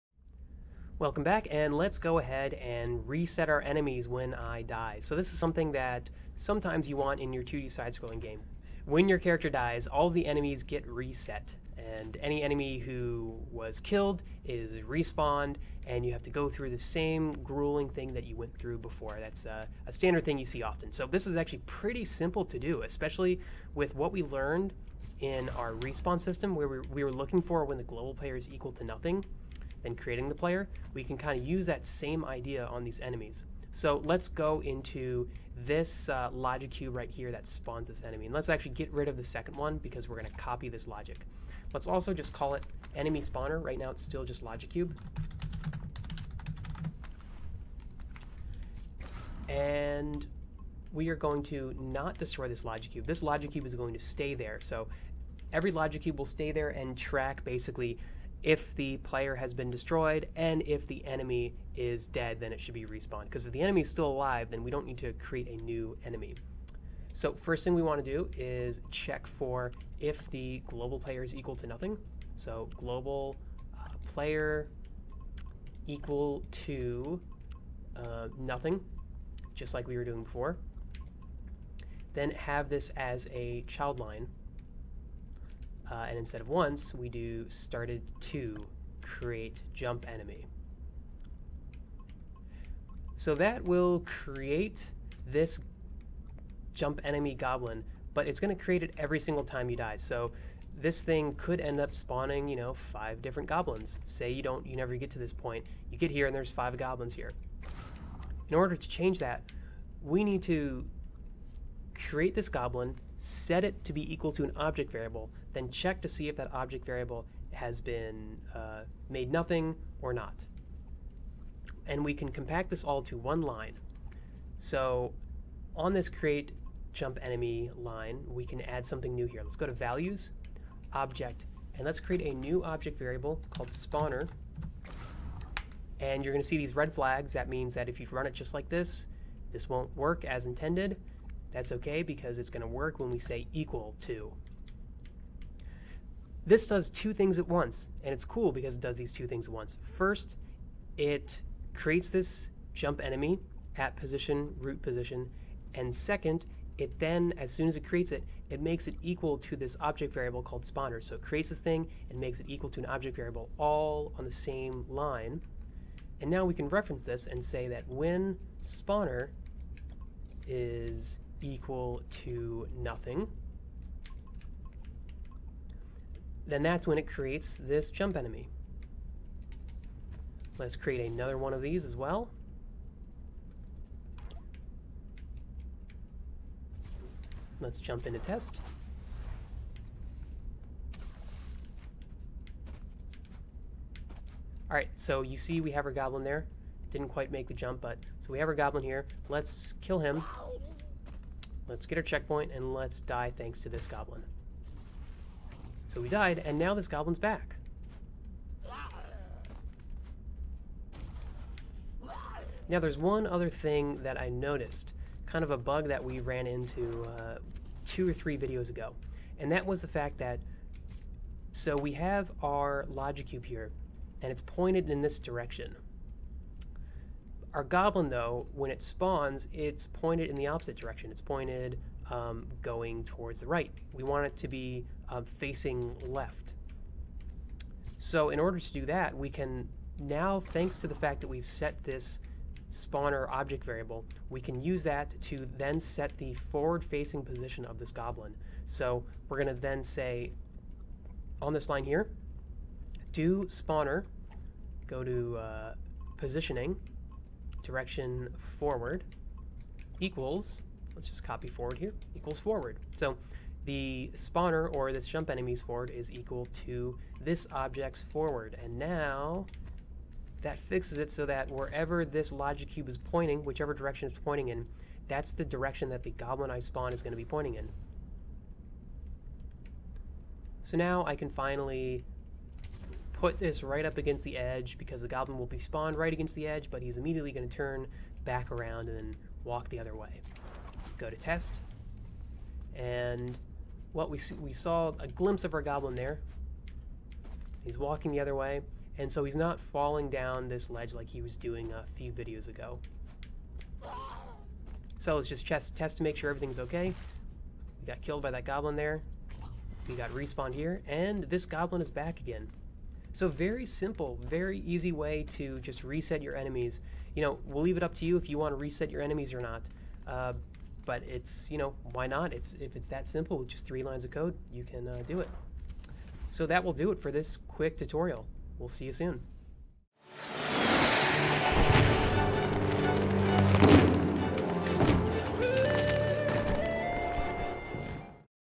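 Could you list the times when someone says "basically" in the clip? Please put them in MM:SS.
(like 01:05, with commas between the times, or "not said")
00:57.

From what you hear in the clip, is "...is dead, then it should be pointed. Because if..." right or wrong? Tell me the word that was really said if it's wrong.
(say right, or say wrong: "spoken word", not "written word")
wrong: "respawned", not "pointed".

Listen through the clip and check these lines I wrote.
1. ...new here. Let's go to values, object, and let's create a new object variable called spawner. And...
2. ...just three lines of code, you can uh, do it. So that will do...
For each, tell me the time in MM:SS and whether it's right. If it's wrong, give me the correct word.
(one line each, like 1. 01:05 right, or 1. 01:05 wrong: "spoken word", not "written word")
1. 02:09 right
2. 05:23 right.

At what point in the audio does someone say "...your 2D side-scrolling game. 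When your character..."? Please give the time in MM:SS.
00:07.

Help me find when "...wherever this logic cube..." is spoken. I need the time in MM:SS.
04:31.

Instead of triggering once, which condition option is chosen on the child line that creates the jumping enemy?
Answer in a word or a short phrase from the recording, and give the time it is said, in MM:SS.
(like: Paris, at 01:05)
started, at 01:27.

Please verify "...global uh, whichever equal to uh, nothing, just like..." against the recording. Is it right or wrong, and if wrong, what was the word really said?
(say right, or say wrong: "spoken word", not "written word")
wrong: "player", not "whichever".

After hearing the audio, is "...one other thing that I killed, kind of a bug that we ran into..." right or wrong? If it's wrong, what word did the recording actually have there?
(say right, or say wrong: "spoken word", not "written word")
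wrong: "noticed", not "killed".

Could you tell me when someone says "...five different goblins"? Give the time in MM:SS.
01:42.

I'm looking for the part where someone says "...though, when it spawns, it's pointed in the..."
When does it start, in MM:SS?
03:48.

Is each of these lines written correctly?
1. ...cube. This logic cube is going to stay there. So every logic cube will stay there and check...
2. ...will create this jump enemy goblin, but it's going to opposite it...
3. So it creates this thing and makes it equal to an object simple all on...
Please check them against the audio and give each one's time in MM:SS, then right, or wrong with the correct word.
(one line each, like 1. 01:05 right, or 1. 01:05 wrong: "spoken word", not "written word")
1. 00:52 wrong: "track", not "check"
2. 01:33 wrong: "create", not "opposite"
3. 02:41 wrong: "variable", not "simple".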